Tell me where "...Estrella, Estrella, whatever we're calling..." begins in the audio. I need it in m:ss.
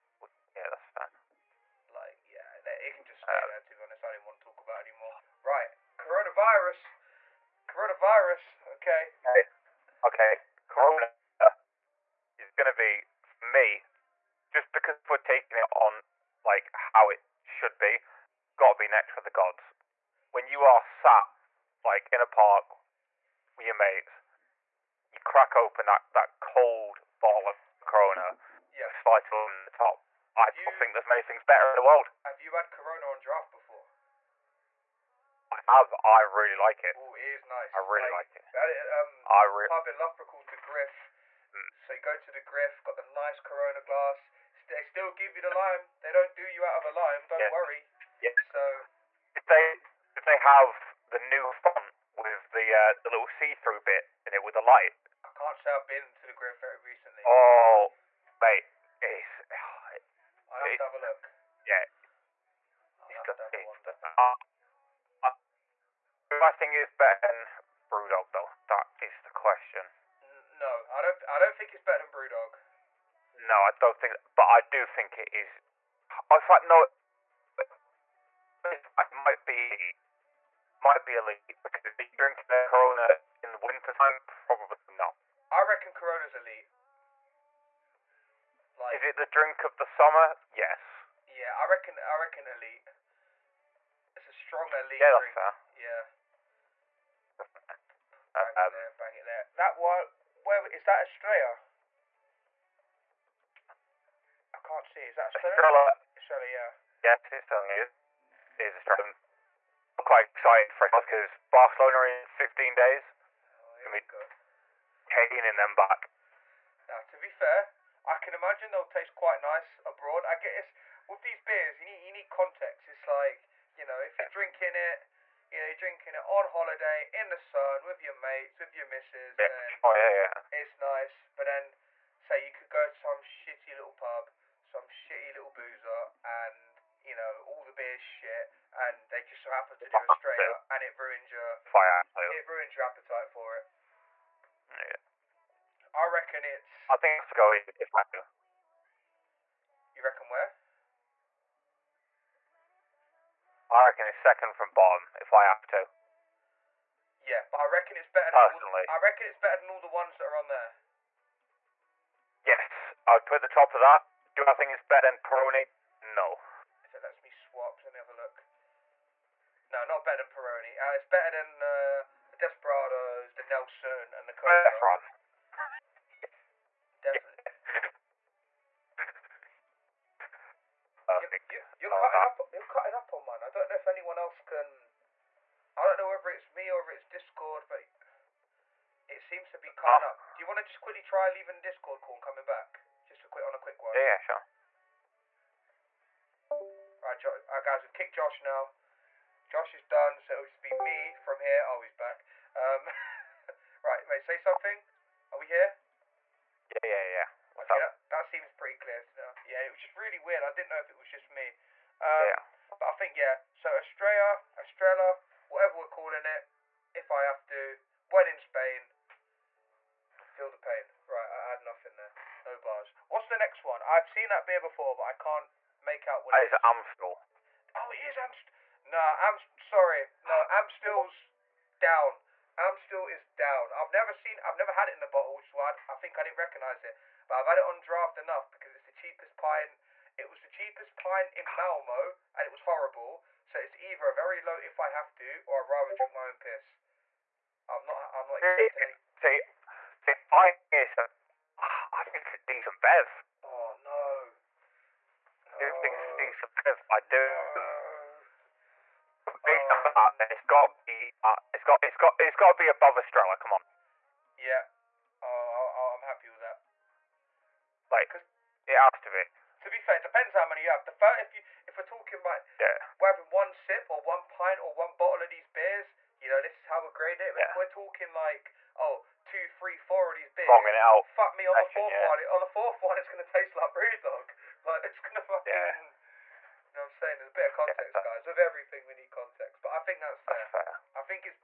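3:33.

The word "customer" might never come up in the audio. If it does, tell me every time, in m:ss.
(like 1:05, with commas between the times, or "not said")
not said.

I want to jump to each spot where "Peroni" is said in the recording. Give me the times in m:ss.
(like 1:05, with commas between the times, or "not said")
2:45, 2:50.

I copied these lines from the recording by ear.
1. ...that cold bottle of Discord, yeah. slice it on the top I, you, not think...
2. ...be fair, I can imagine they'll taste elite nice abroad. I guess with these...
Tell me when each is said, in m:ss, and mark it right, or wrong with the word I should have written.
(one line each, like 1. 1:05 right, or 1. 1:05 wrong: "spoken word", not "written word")
1. 0:26 wrong: "Corona", not "Discord"
2. 1:57 wrong: "quite", not "elite".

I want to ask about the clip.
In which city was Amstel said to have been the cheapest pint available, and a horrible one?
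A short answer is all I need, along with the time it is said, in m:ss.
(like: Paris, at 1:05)
Malmo, at 4:01.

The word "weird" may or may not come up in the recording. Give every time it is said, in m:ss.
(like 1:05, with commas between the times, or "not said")
3:30.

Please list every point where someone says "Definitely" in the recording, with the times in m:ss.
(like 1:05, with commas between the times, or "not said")
2:57.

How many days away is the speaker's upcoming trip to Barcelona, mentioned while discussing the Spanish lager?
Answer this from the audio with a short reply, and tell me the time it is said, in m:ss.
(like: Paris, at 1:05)
15, at 1:52.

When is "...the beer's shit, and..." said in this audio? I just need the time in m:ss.
2:17.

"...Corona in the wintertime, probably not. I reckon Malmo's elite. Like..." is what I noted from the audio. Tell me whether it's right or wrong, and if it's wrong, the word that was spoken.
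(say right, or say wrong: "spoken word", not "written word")
wrong: "Corona", not "Malmo".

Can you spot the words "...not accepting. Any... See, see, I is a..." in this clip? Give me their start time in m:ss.
4:08.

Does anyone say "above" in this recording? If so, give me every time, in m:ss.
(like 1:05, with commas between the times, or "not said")
4:22.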